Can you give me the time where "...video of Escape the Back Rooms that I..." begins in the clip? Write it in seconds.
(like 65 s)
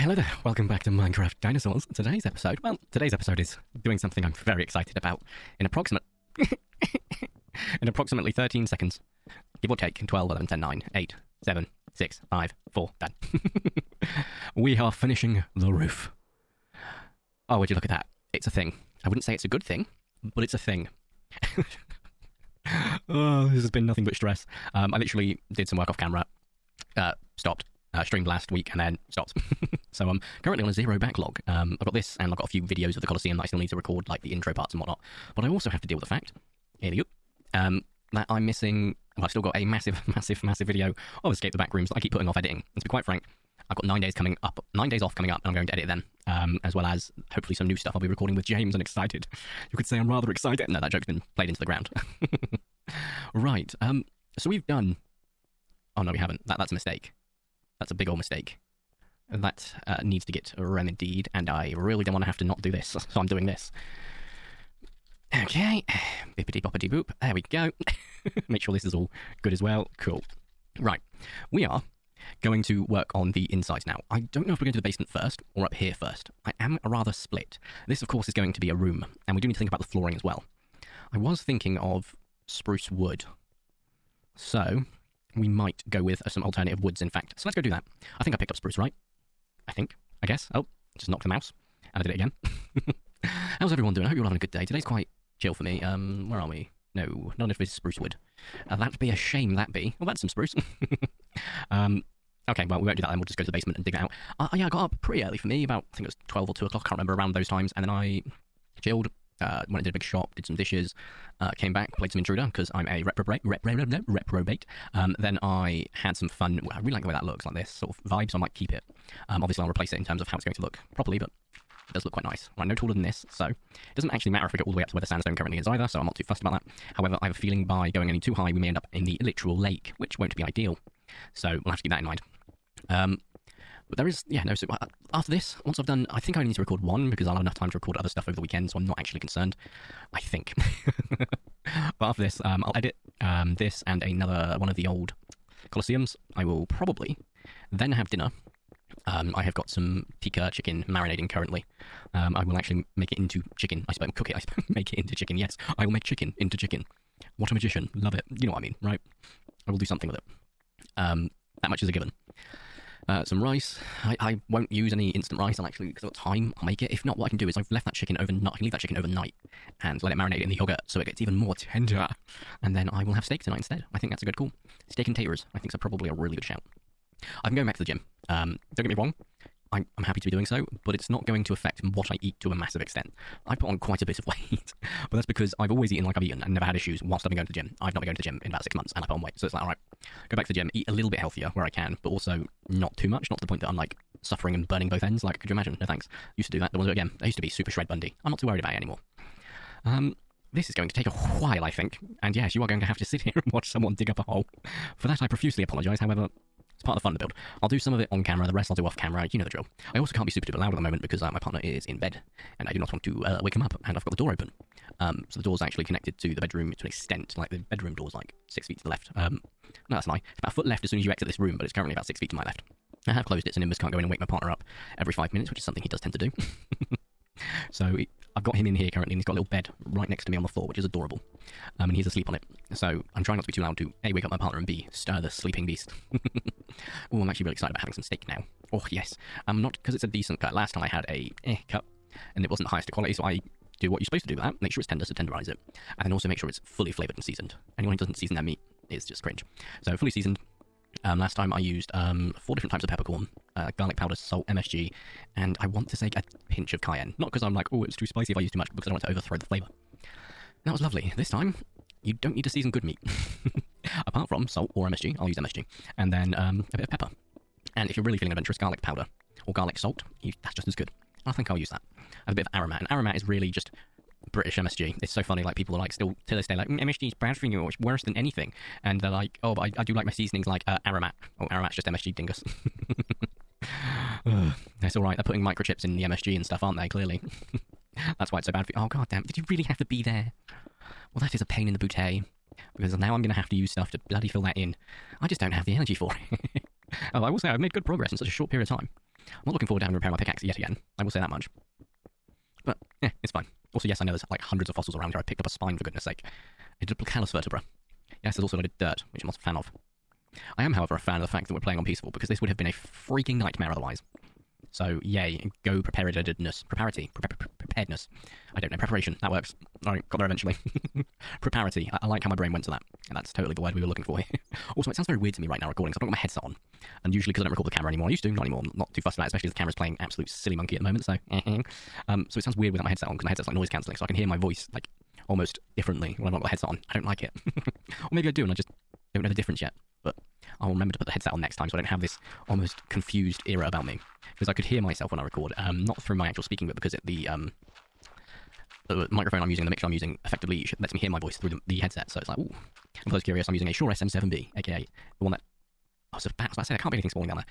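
40 s.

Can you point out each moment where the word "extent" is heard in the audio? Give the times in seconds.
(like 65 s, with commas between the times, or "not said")
182 s, 216 s.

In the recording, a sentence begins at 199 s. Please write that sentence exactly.
Um, this is going to take a while, I think.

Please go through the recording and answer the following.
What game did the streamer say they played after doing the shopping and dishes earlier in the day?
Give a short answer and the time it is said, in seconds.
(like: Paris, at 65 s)
Intruder, at 112 s.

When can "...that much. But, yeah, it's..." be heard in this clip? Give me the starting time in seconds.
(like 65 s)
301 s.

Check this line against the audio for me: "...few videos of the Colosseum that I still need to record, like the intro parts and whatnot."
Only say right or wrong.
right.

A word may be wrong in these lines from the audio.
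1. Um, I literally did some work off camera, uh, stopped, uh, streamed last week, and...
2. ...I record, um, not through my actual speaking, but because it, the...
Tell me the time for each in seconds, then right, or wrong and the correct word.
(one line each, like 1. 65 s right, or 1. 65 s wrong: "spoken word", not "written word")
1. 24 s right
2. 345 s right.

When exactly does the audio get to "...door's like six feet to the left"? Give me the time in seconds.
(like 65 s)
217 s.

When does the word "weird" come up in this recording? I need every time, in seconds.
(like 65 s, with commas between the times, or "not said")
325 s, 332 s.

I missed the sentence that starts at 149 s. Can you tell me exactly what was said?
Um, I have got some tikka chicken marinating currently.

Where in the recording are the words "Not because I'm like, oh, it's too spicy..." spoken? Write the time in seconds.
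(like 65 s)
257 s.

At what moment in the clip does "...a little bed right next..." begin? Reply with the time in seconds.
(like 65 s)
229 s.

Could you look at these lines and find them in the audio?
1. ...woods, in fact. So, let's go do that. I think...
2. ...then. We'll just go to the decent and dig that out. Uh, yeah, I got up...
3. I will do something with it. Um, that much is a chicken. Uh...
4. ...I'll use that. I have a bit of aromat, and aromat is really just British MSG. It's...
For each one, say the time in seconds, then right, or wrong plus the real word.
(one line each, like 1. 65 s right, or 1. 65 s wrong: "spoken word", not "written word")
1. 86 s right
2. 103 s wrong: "basement", not "decent"
3. 159 s wrong: "given", not "chicken"
4. 271 s right.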